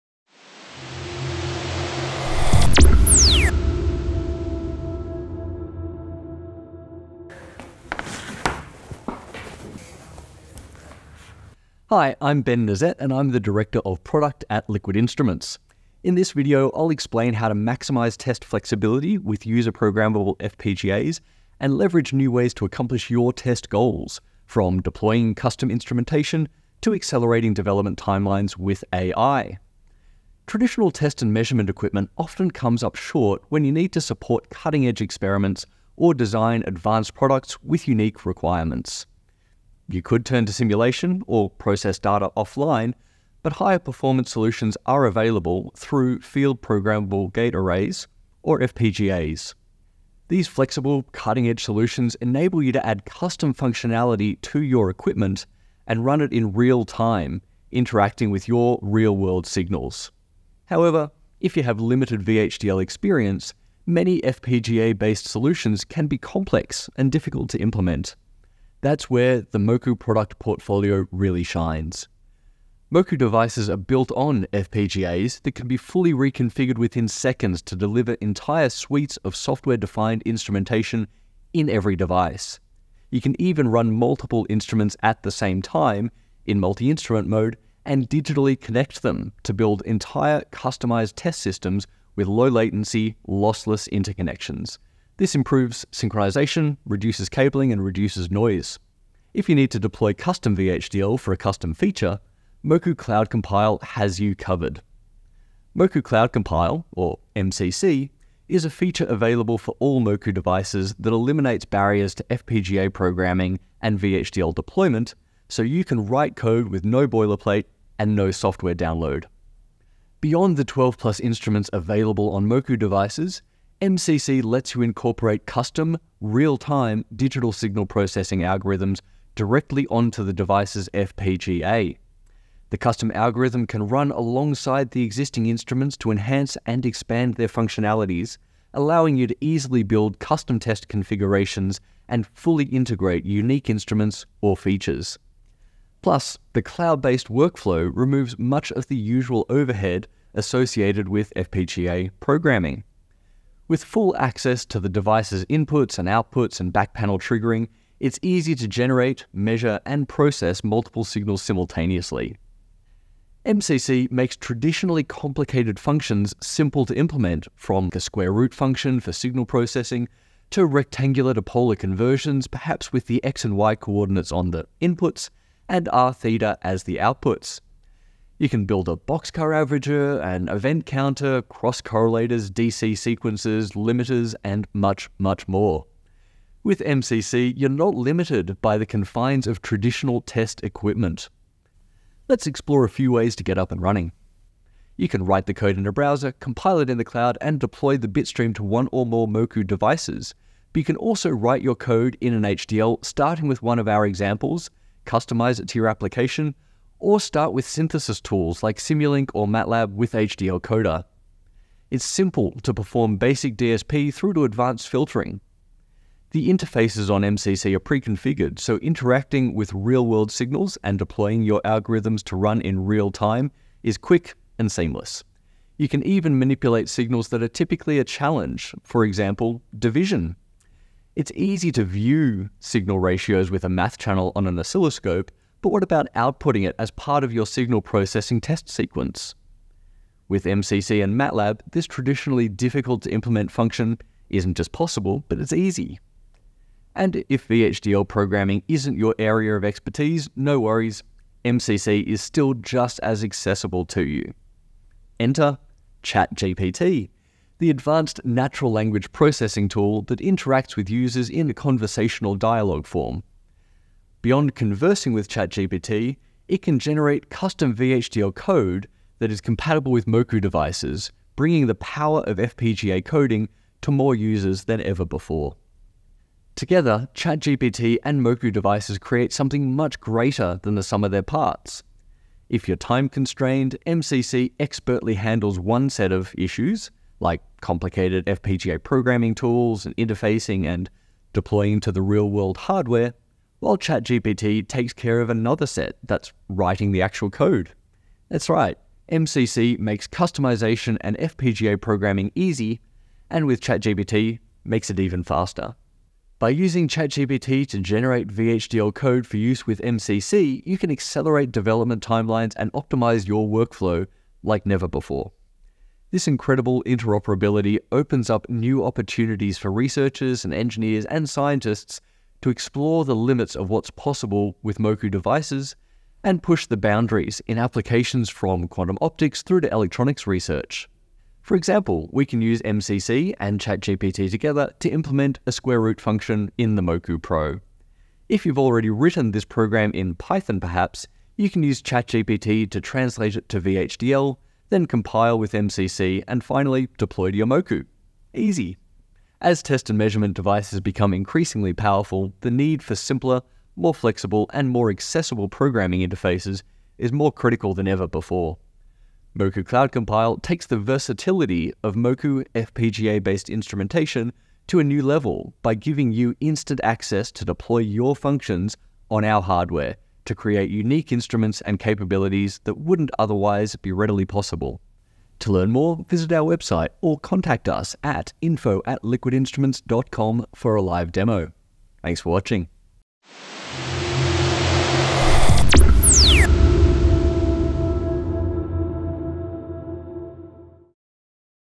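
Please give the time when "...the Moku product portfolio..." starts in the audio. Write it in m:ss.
1:09.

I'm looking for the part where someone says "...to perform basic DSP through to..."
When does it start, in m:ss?
3:32.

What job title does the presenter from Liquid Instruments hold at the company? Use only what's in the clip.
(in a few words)
Director of Product.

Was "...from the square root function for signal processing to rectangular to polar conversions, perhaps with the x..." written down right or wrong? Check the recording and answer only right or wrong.
right.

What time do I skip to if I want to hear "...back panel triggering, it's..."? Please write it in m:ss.
2:36.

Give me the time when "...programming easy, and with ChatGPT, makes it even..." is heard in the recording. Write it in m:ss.
5:01.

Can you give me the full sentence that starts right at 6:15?
To learn more, visit our website or contact us at info at liquidinstruments.com for a live demo.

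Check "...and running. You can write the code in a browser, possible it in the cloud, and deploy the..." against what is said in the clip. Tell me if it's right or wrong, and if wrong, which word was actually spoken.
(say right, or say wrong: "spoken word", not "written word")
wrong: "compile", not "possible".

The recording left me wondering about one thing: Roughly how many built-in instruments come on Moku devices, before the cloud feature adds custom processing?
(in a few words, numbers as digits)
12 plus.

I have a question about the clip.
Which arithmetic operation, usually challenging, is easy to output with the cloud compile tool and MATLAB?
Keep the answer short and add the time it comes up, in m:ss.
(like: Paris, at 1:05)
division, at 3:49.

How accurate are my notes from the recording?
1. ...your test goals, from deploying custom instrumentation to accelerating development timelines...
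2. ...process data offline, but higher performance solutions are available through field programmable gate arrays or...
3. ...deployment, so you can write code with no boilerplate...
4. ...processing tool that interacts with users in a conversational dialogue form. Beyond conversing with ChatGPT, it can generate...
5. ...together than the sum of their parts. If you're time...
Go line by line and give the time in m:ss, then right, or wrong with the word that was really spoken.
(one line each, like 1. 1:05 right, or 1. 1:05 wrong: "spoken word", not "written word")
1. 0:23 right
2. 0:41 right
3. 1:54 right
4. 4:19 right
5. 4:39 wrong: "greater", not "together".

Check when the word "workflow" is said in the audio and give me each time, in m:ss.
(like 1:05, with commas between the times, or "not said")
2:27, 5:13.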